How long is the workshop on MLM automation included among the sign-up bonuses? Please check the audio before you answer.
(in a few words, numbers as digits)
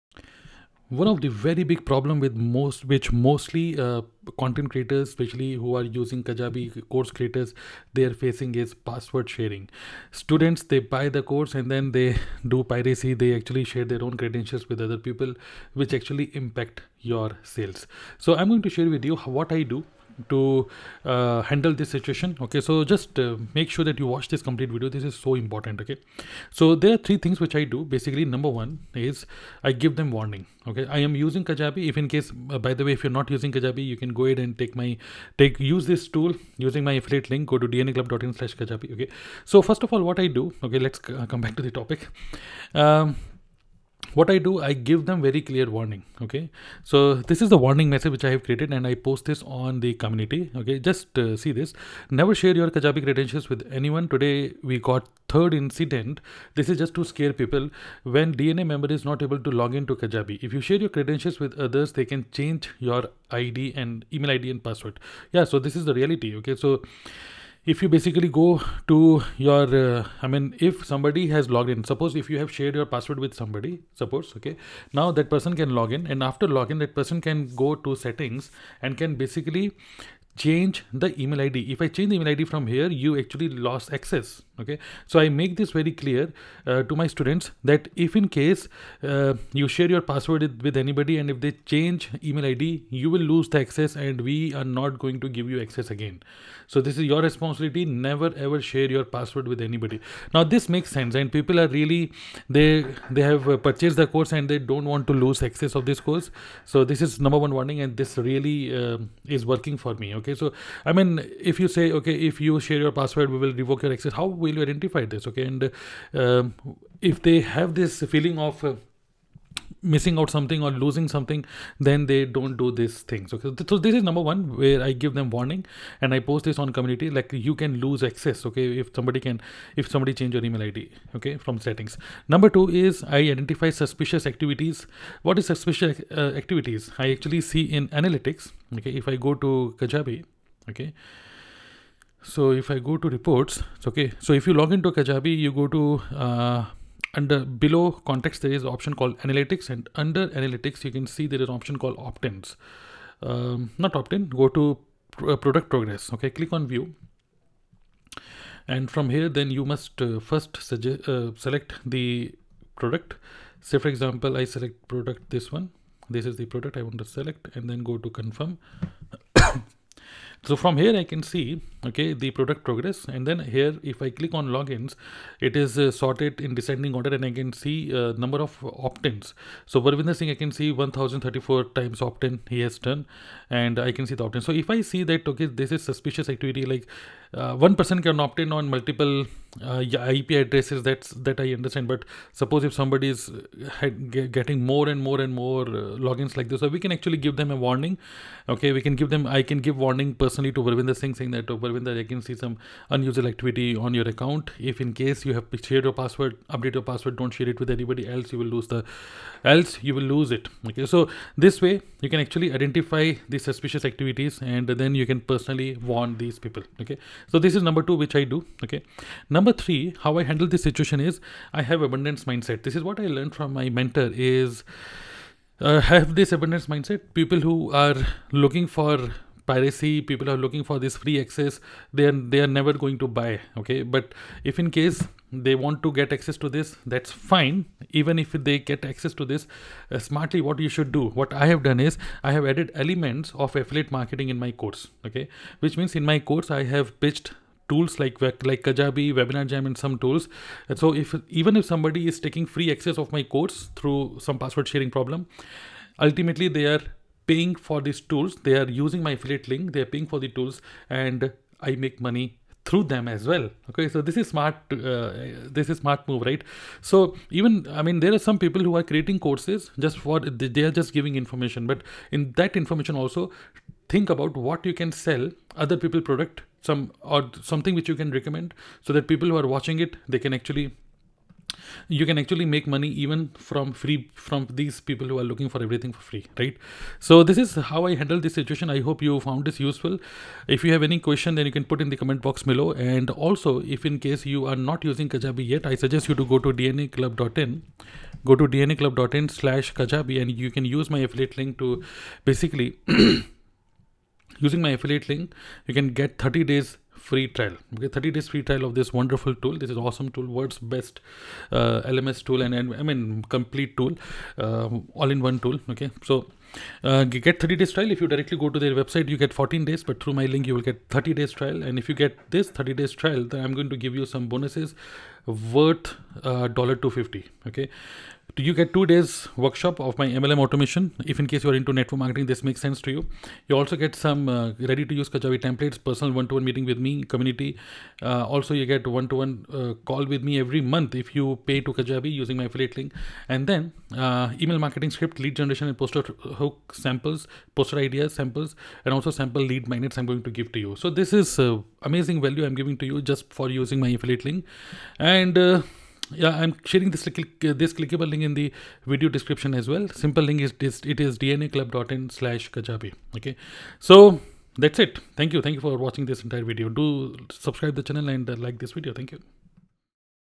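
2 days.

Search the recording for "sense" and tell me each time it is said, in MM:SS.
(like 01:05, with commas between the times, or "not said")
01:40, 05:32.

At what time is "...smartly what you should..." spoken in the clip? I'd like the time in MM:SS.
03:59.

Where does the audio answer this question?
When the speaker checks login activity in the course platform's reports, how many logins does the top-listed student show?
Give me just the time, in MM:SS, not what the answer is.
03:00.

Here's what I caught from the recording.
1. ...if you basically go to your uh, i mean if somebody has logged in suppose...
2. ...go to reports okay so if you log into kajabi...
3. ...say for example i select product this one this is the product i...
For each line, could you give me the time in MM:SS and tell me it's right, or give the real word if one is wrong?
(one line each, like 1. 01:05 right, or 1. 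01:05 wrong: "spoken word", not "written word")
1. 01:07 right
2. 02:22 right
3. 02:43 right.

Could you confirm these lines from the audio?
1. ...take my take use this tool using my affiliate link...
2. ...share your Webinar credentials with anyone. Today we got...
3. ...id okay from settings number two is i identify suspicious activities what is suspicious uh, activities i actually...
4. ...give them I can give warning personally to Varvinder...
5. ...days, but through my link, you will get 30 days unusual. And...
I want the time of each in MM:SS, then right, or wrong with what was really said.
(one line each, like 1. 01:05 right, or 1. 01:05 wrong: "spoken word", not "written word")
1. 00:34 right
2. 00:52 wrong: "Kajabi", not "Webinar"
3. 02:10 right
4. 03:18 right
5. 05:19 wrong: "trial", not "unusual".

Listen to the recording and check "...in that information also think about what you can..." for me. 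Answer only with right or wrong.
right.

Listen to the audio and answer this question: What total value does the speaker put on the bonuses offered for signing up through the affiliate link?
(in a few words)
$250.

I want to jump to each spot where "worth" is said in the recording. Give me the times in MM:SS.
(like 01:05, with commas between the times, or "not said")
05:25.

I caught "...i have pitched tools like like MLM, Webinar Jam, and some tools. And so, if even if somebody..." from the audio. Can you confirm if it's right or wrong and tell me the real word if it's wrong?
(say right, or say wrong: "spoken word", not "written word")
wrong: "Kajabi", not "MLM".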